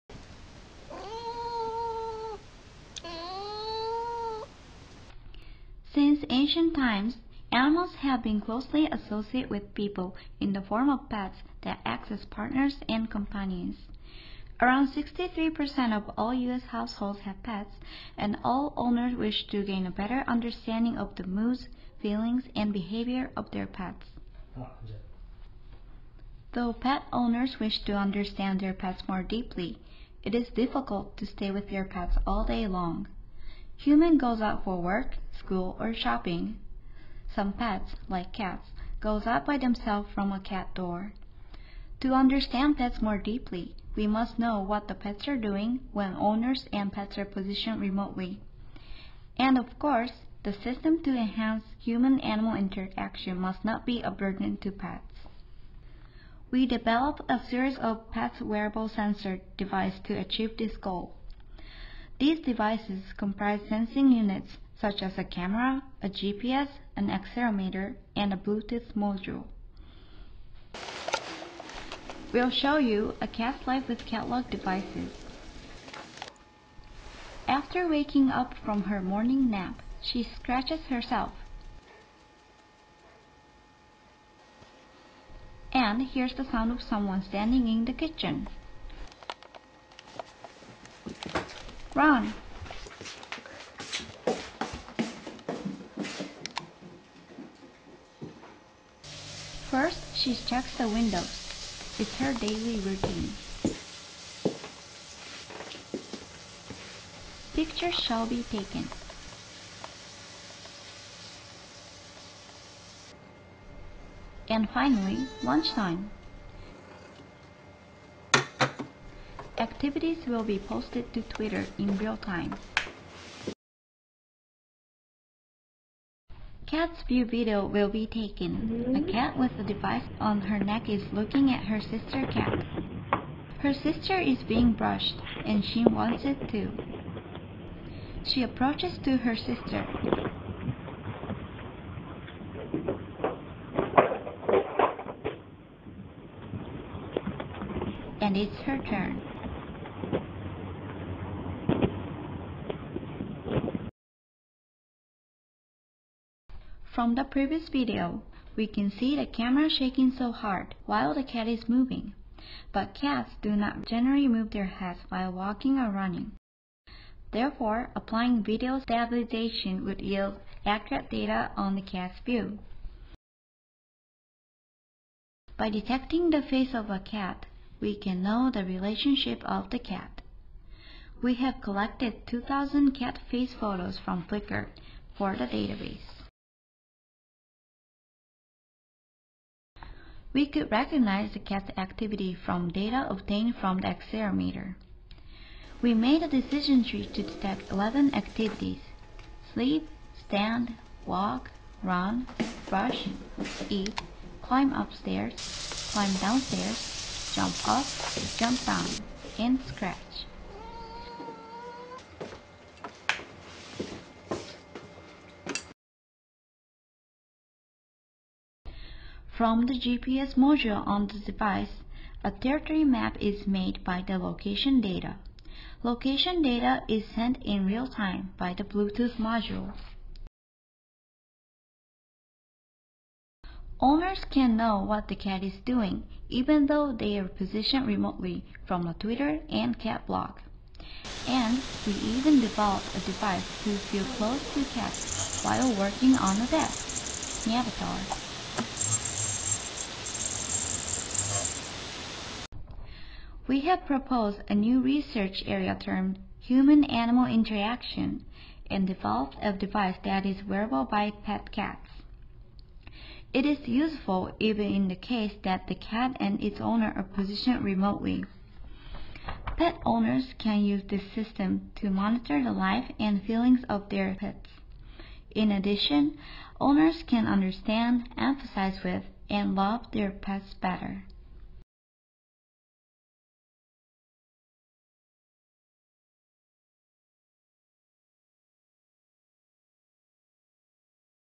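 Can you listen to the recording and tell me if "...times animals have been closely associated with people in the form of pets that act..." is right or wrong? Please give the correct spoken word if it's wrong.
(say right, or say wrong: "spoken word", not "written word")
right.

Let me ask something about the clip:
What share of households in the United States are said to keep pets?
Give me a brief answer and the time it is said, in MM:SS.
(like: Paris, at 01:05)
63%, at 00:14.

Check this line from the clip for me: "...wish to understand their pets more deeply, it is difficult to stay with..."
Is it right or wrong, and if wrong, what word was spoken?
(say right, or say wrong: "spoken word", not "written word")
right.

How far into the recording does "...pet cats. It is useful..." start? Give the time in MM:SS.
04:21.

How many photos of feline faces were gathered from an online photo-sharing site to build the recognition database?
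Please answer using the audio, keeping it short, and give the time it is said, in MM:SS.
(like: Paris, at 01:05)
2,000, at 03:02.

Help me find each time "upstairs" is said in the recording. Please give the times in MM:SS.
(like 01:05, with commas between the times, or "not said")
03:24.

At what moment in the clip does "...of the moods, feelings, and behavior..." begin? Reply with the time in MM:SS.
00:20.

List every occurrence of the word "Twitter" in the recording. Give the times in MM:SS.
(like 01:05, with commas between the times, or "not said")
02:01, 03:58.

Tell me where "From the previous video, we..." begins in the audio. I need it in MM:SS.
02:36.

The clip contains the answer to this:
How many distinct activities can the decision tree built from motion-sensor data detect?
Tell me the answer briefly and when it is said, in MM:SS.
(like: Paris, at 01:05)
11, at 03:17.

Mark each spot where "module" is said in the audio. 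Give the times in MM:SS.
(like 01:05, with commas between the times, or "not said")
01:08, 03:40, 03:49.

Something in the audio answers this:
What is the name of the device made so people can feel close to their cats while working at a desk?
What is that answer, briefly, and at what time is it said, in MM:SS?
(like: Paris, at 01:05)
Neavatar, at 04:07.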